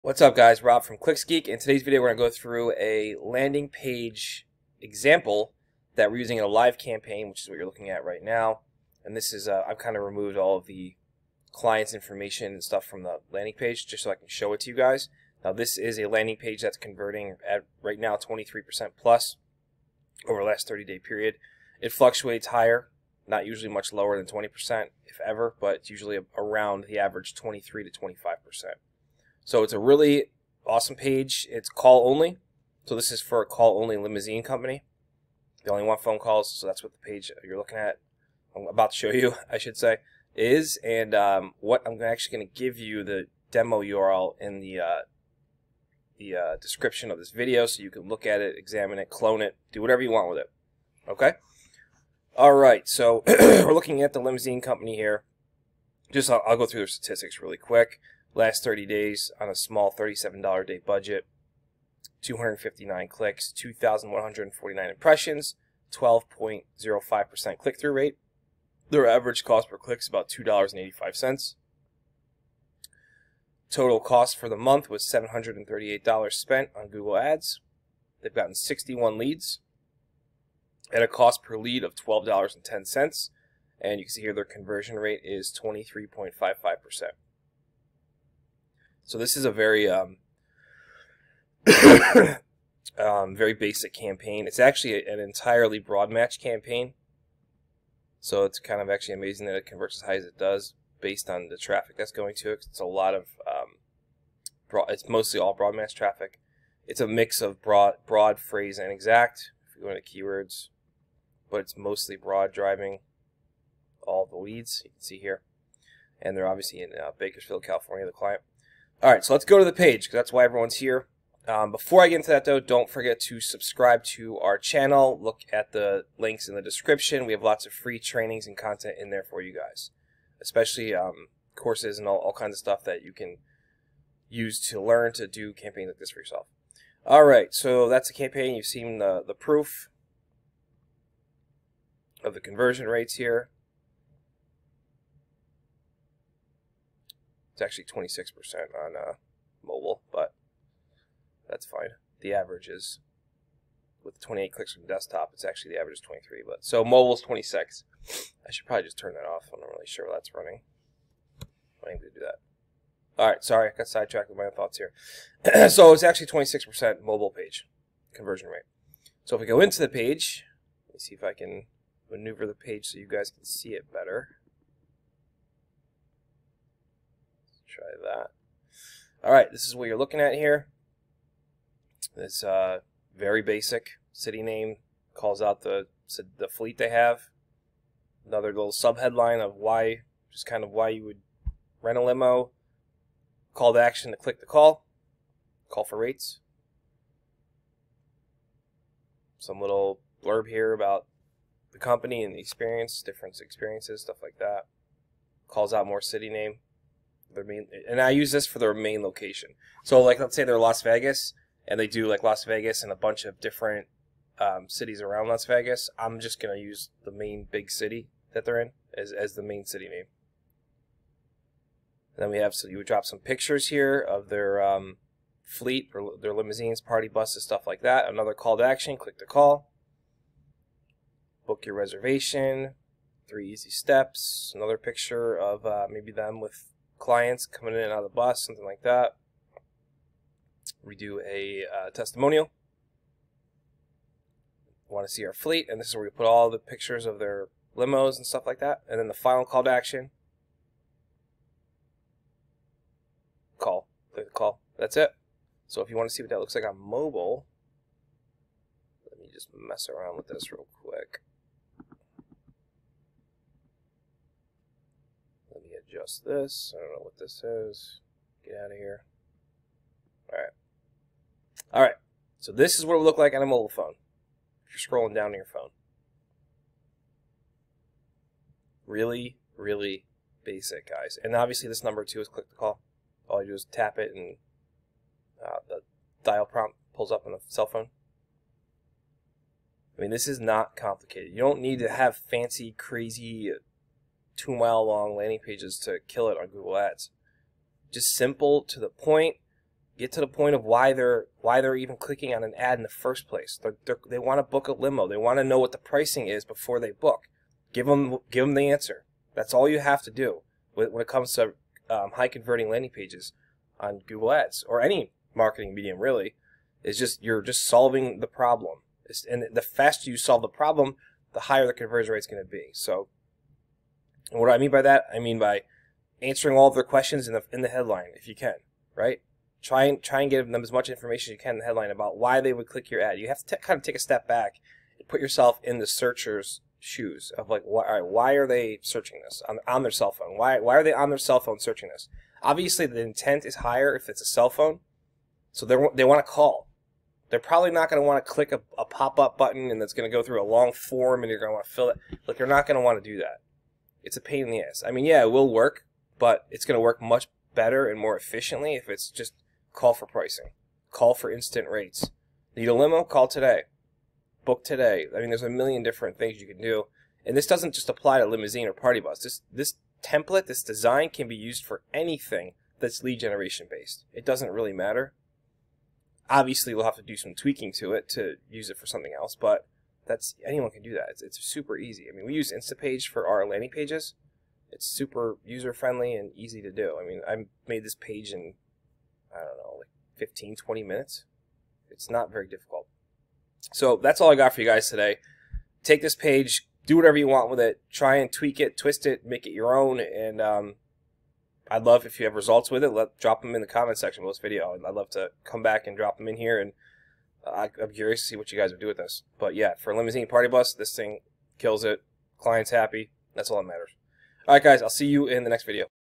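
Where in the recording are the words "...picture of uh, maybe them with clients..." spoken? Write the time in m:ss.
3:54.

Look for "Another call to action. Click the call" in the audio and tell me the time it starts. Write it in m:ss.
3:48.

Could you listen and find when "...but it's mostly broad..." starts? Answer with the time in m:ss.
1:51.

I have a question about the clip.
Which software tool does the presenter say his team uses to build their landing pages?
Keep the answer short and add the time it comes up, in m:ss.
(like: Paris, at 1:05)
Instapage, at 6:22.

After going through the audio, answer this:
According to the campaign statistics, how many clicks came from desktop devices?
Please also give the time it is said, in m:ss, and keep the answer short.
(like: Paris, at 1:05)
28, at 2:34.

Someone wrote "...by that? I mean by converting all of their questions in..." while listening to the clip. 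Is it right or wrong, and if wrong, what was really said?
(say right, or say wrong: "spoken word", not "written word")
wrong: "answering", not "converting".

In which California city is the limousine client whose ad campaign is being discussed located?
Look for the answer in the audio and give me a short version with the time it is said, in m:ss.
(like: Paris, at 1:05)
Bakersfield, at 1:57.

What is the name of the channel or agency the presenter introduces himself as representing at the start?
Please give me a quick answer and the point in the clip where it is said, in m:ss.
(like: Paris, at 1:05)
Clicks Geek, at 0:00.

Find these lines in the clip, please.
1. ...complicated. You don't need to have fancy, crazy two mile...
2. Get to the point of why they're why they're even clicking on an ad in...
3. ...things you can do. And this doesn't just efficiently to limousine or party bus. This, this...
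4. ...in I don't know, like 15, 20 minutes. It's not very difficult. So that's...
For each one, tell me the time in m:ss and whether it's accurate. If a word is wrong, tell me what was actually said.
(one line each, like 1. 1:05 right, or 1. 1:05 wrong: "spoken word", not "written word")
1. 4:50 right
2. 4:59 right
3. 6:06 wrong: "apply", not "efficiently"
4. 6:28 right.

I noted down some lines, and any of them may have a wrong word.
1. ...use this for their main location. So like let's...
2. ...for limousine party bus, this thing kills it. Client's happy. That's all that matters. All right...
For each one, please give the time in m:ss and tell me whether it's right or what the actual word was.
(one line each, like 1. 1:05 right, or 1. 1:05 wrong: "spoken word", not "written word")
1. 3:28 right
2. 6:49 right.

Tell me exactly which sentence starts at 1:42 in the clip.
It's a lot of um, broad, it's mostly all broad match traffic.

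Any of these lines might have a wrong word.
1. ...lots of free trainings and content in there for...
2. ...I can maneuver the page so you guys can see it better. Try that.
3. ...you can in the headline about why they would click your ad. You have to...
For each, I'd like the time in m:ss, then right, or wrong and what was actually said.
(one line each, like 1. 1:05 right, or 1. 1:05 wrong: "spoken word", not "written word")
1. 2:07 right
2. 2:51 right
3. 5:31 right.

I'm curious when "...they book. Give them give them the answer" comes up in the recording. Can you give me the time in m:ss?
5:06.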